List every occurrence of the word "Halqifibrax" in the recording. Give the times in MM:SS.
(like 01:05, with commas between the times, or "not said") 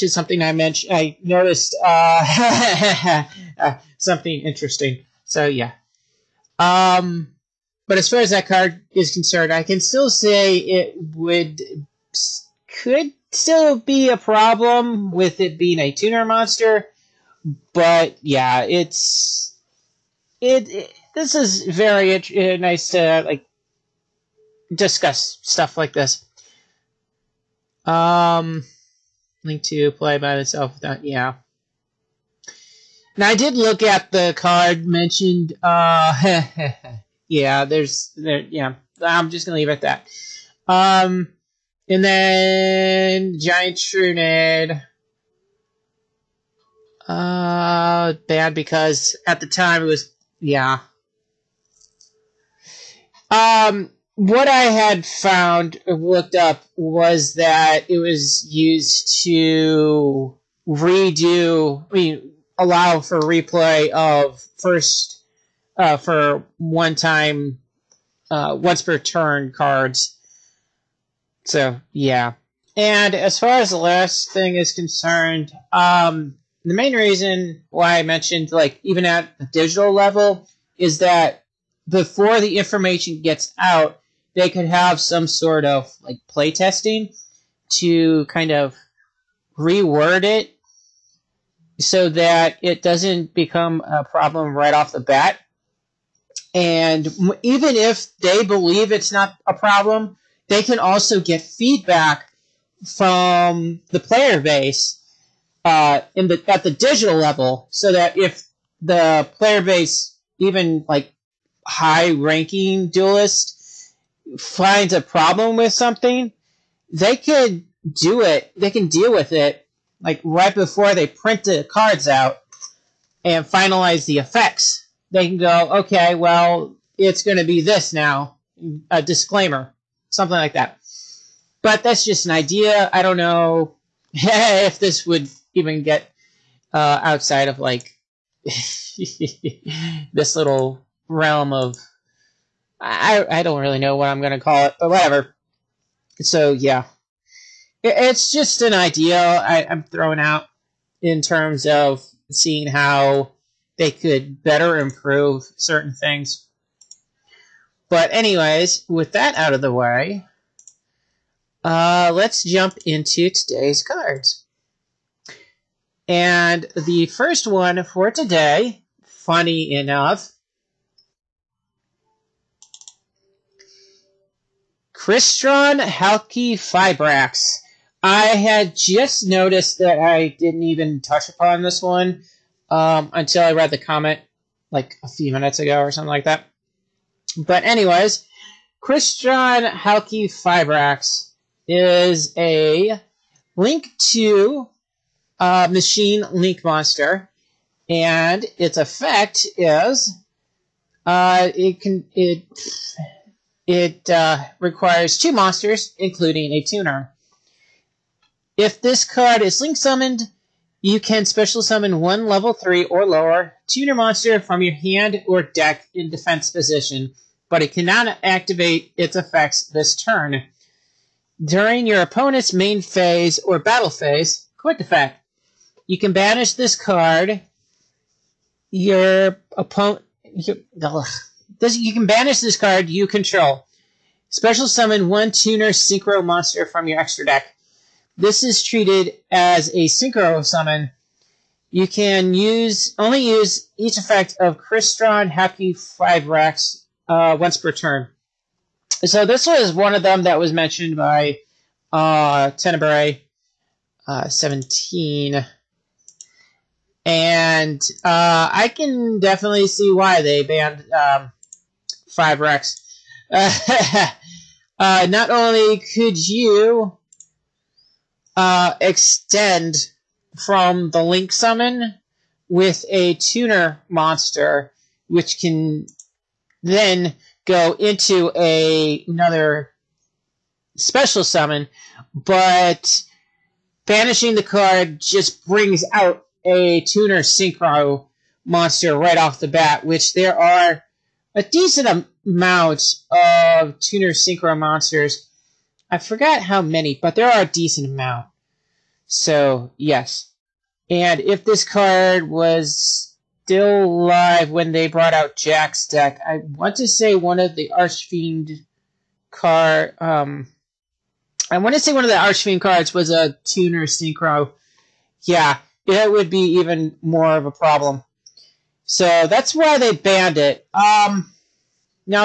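02:55, 04:05.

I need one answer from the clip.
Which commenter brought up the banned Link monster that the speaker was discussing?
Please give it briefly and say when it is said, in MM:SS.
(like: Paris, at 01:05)
Tenebrae 17, at 04:12.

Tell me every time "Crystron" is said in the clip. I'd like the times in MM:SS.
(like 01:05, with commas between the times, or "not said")
02:54, 04:04.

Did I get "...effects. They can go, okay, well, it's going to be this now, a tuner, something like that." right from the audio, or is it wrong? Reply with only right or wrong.
wrong.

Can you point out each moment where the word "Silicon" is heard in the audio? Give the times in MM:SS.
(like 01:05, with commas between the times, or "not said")
not said.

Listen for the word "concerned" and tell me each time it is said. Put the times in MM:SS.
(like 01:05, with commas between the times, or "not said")
00:09, 01:14.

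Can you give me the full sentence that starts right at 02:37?
But anyways, with that out of the way, uh, let's jump into today's cards.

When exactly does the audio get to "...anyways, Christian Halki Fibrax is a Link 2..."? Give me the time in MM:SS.
03:07.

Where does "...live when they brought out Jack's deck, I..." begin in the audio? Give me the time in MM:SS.
05:04.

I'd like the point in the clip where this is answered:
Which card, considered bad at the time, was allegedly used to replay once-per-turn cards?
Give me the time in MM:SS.
00:43.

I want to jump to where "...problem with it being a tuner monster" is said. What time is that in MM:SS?
00:14.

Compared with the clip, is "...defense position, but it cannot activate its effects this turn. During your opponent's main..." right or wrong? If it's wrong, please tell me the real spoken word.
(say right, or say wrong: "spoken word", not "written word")
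right.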